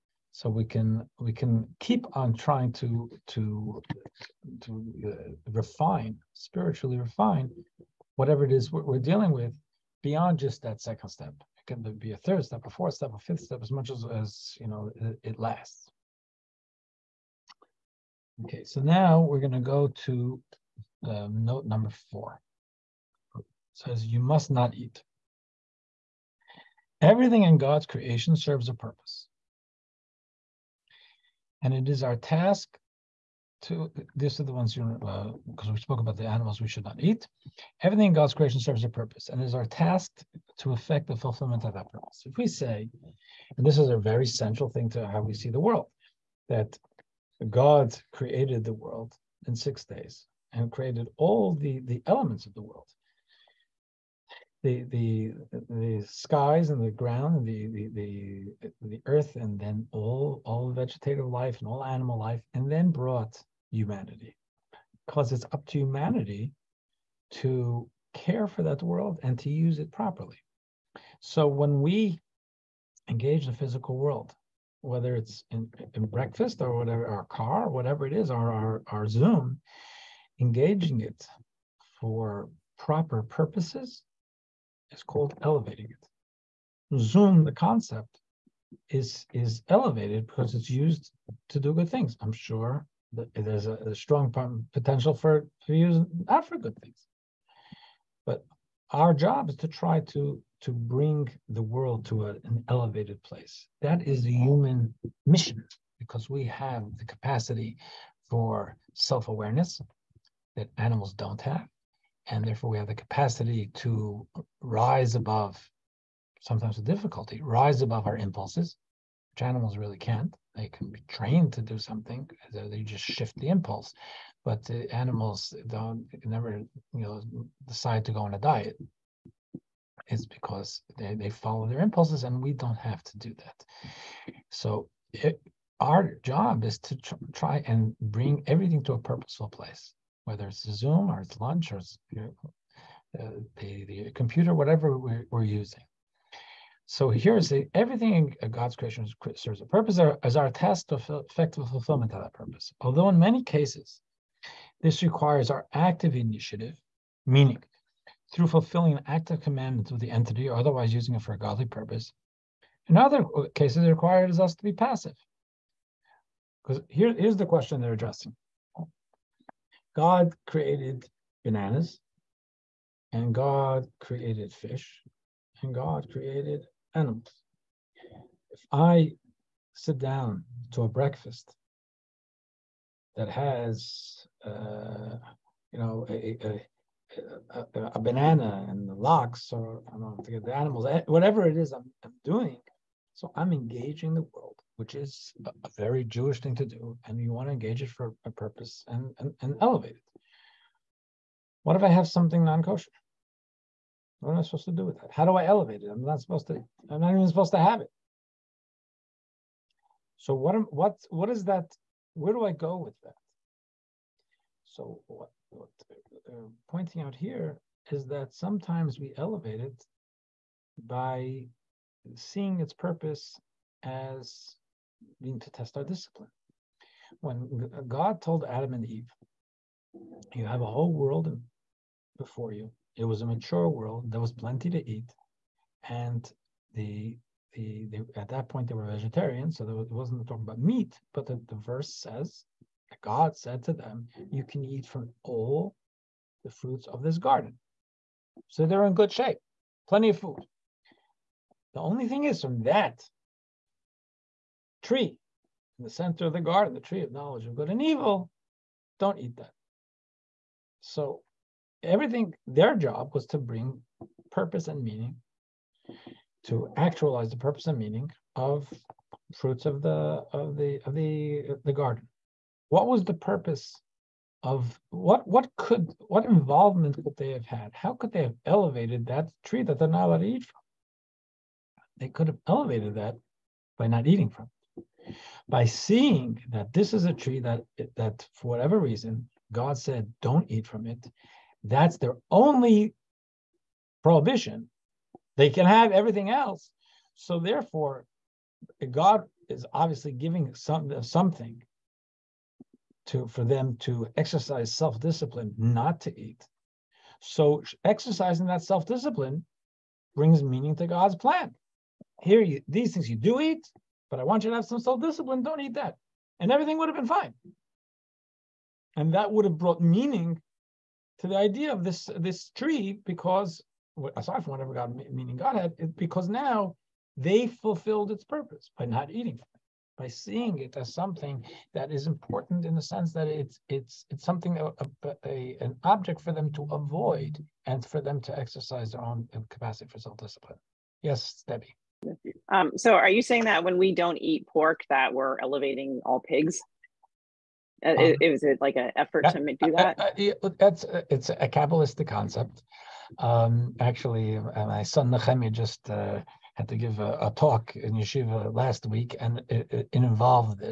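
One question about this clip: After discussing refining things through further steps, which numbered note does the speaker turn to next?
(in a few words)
Note number four.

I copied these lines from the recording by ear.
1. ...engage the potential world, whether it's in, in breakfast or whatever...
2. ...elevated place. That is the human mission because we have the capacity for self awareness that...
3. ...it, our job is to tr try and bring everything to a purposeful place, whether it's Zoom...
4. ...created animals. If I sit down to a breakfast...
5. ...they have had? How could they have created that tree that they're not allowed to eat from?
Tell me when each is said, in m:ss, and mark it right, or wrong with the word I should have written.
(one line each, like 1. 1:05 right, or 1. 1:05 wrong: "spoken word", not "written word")
1. 1:13 wrong: "physical", not "potential"
2. 1:42 right
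3. 2:15 right
4. 2:56 right
5. 4:37 wrong: "elevated", not "created".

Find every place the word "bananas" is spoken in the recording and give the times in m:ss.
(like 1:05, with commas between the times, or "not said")
2:51, 3:07.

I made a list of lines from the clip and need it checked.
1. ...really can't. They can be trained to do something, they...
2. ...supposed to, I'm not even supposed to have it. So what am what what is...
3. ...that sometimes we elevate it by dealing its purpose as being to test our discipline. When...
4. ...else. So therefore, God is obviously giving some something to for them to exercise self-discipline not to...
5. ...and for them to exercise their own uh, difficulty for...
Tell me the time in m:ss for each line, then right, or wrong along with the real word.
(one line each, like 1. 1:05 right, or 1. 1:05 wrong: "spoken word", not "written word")
1. 1:59 right
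2. 3:26 right
3. 3:38 wrong: "seeing", not "dealing"
4. 4:56 right
5. 5:37 wrong: "capacity", not "difficulty".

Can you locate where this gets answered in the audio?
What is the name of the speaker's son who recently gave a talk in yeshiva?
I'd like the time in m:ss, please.
5:55.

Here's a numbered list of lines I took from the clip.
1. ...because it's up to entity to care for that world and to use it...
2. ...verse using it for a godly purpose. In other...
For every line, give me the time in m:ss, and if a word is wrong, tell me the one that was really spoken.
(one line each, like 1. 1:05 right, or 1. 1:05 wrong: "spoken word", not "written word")
1. 1:05 wrong: "humanity", not "entity"
2. 2:40 wrong: "otherwise", not "verse".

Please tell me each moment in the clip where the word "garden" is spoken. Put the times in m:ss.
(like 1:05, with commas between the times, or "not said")
4:07, 4:16, 4:31.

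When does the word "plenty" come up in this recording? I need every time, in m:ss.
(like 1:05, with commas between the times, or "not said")
3:54, 4:09.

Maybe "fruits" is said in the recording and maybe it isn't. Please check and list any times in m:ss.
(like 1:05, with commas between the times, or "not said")
4:06, 4:29.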